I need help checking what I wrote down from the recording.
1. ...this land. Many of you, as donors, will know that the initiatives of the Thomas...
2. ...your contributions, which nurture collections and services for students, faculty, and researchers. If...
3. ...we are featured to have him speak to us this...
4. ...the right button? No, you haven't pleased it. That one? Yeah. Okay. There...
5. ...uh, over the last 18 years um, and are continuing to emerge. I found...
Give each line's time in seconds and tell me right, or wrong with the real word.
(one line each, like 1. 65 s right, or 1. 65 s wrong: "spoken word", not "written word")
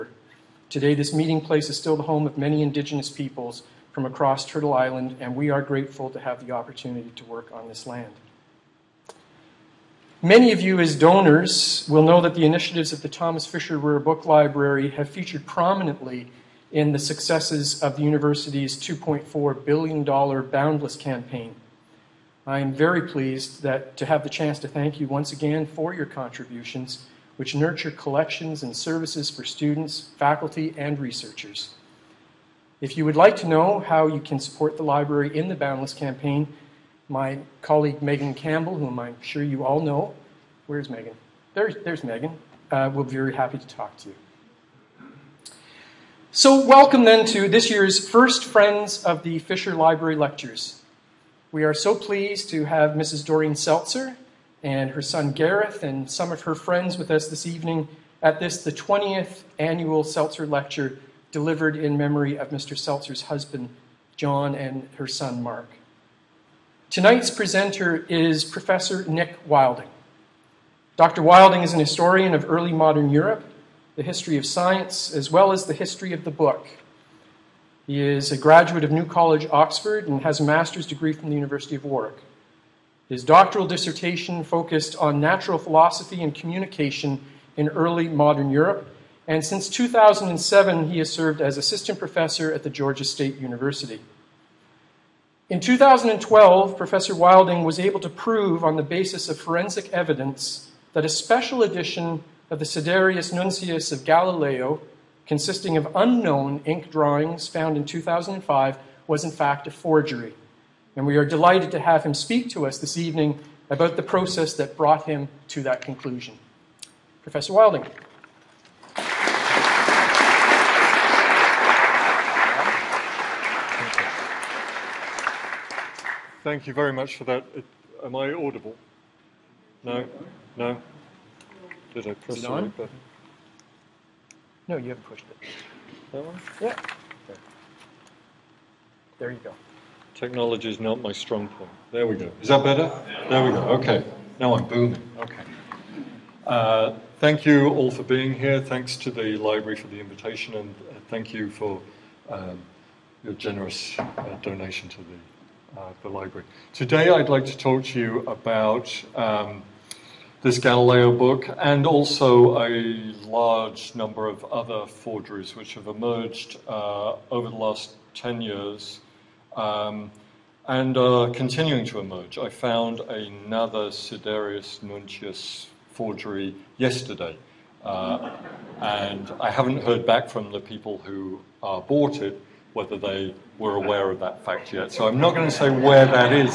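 1. 7 s right
2. 25 s right
3. 111 s wrong: "delighted", not "featured"
4. 132 s wrong: "pushed", not "pleased"
5. 166 s wrong: "10", not "18".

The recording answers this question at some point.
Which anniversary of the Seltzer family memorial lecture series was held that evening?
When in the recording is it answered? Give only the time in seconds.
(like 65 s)
58 s.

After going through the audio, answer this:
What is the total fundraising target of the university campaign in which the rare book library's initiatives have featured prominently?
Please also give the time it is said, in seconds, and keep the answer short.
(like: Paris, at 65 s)
$2.4 billion, at 18 s.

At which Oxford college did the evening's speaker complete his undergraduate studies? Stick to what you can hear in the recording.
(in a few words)
New College.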